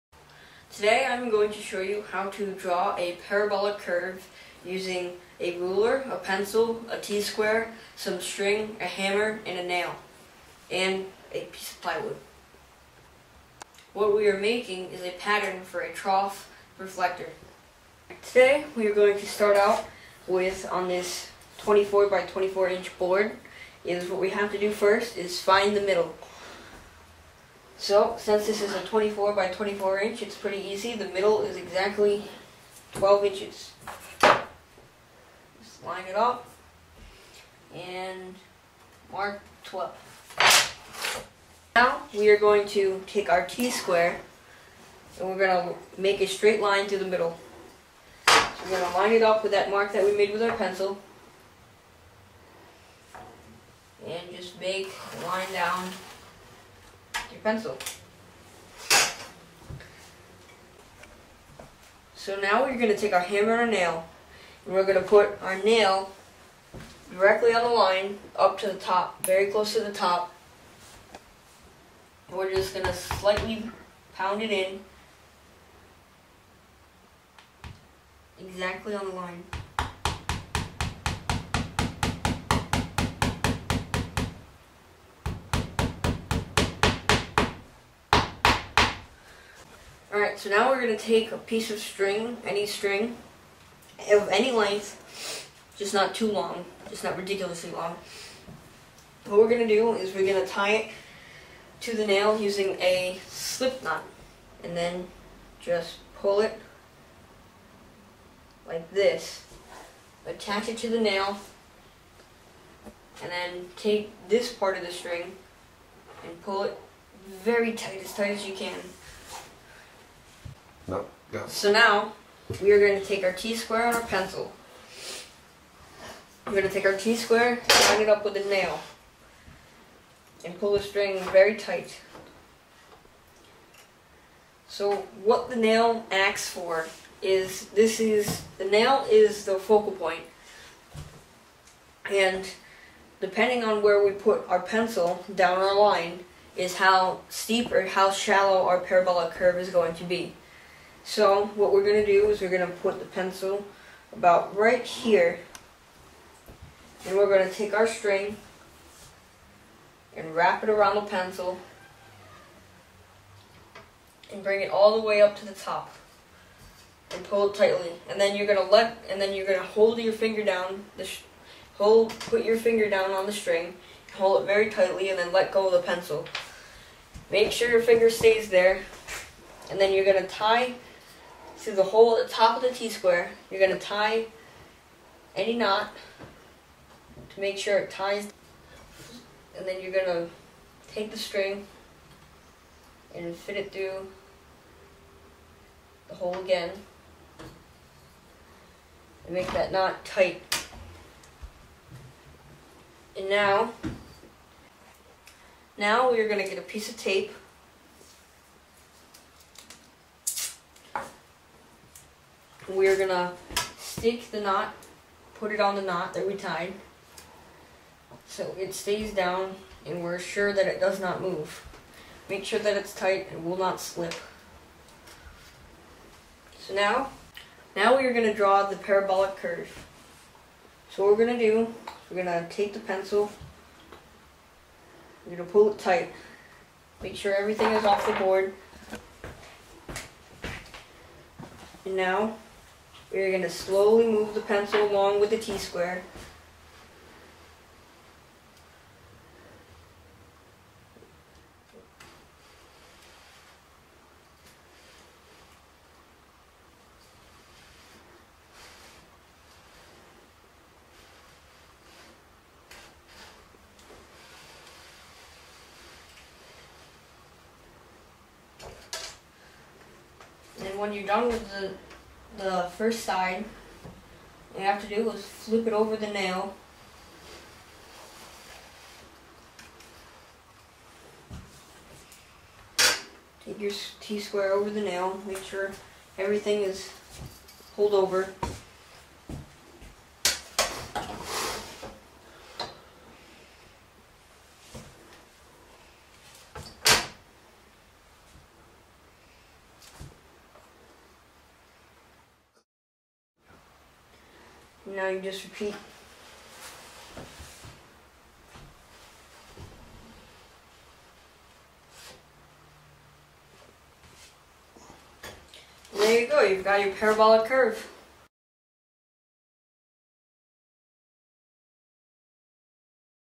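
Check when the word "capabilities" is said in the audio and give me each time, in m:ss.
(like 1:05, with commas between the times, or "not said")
not said.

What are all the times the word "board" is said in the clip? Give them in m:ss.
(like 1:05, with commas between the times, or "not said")
0:22, 3:58.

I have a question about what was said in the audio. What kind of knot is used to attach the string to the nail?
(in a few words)
slip knot.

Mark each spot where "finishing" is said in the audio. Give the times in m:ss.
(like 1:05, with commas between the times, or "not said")
not said.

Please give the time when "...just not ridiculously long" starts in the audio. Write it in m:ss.
1:36.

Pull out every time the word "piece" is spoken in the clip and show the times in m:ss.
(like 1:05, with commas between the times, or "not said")
0:11, 1:31, 3:26.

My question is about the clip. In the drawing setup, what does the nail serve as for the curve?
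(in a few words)
focal point.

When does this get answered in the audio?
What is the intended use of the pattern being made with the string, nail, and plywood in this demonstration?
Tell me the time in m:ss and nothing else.
0:15.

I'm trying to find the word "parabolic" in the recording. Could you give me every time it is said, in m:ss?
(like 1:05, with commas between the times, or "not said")
0:03, 2:28, 3:48, 5:16.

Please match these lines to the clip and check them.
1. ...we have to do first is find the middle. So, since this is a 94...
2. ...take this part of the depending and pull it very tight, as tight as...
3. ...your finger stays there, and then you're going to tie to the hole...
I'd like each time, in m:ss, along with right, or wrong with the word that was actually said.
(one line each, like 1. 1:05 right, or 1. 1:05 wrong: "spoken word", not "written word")
1. 0:24 wrong: "24", not "94"
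2. 1:53 wrong: "string", not "depending"
3. 2:57 right.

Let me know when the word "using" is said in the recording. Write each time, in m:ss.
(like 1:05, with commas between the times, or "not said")
0:04, 1:42.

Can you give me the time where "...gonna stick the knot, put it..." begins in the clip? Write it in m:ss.
3:32.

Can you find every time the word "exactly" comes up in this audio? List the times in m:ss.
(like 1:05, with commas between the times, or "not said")
0:31, 1:18.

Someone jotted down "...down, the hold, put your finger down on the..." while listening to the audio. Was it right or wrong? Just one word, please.
right.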